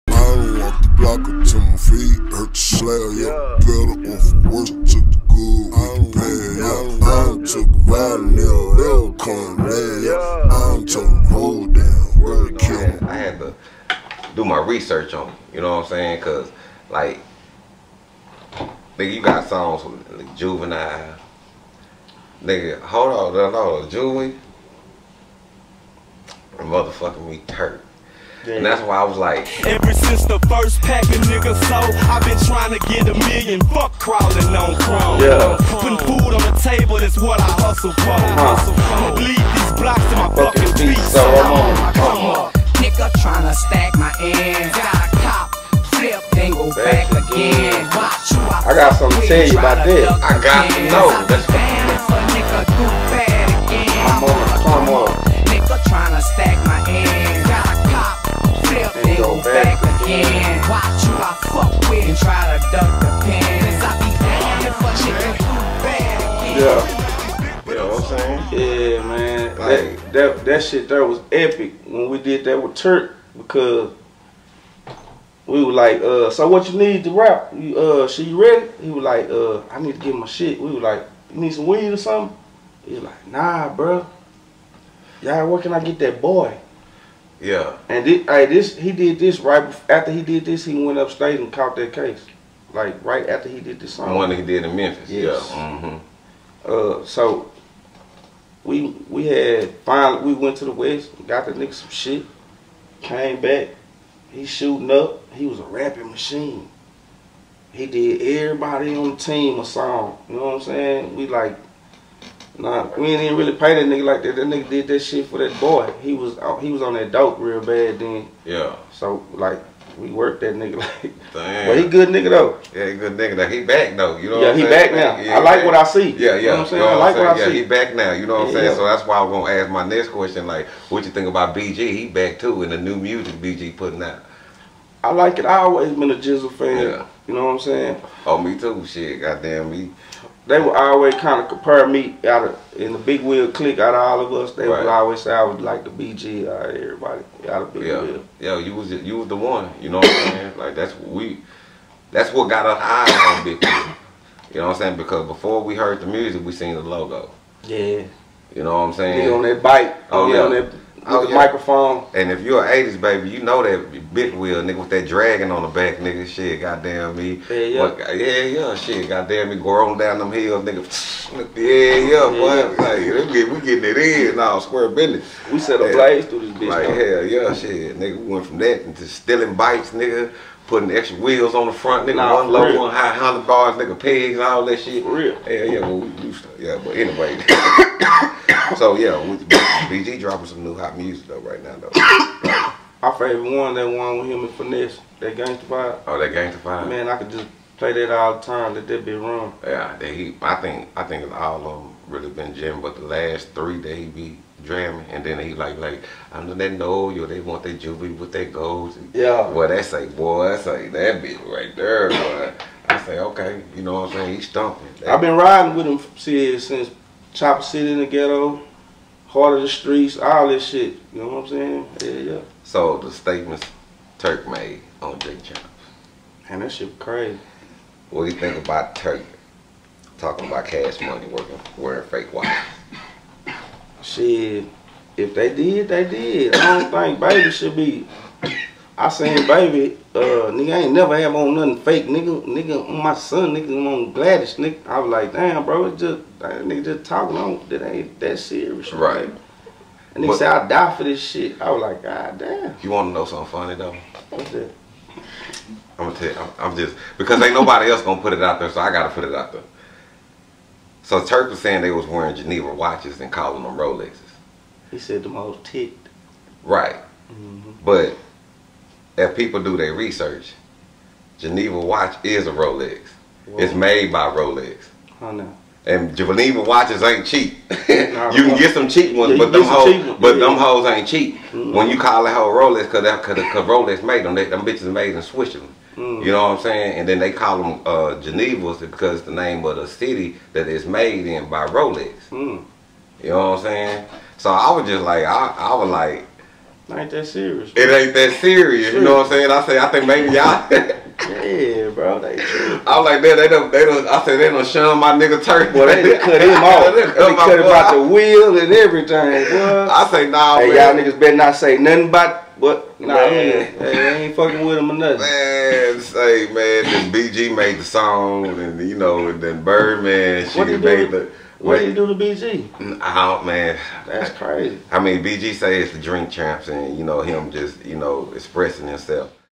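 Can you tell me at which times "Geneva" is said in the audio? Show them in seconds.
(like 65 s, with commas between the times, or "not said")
262 s, 271 s, 276 s, 288 s.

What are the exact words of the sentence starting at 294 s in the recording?
So I was just like, I, I was like, ain't that serious.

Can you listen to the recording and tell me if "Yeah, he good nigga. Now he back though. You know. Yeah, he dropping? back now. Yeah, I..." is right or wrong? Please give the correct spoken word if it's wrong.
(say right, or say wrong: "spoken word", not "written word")
wrong: "saying", not "dropping".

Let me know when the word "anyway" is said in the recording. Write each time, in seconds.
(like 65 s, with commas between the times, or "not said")
186 s.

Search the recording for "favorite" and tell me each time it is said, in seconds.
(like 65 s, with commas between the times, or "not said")
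193 s.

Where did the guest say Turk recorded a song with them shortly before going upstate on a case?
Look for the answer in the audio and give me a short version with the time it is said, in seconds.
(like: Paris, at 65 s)
Memphis, at 94 s.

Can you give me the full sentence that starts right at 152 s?
That's what got us eyes on big wheel.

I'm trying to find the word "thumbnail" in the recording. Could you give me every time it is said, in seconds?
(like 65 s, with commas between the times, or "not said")
not said.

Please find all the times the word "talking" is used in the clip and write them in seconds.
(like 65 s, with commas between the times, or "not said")
230 s, 247 s.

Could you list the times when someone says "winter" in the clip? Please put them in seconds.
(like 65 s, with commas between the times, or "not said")
not said.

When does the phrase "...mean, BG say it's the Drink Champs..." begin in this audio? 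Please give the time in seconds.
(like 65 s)
324 s.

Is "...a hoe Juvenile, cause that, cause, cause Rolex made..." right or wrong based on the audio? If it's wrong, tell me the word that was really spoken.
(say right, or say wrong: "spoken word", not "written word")
wrong: "Rolex", not "Juvenile".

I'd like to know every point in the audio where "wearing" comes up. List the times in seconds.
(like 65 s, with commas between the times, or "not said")
231 s, 262 s.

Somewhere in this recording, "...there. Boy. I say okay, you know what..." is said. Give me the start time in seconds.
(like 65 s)
211 s.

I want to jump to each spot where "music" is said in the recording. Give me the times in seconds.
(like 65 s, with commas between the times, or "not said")
132 s, 156 s, 190 s.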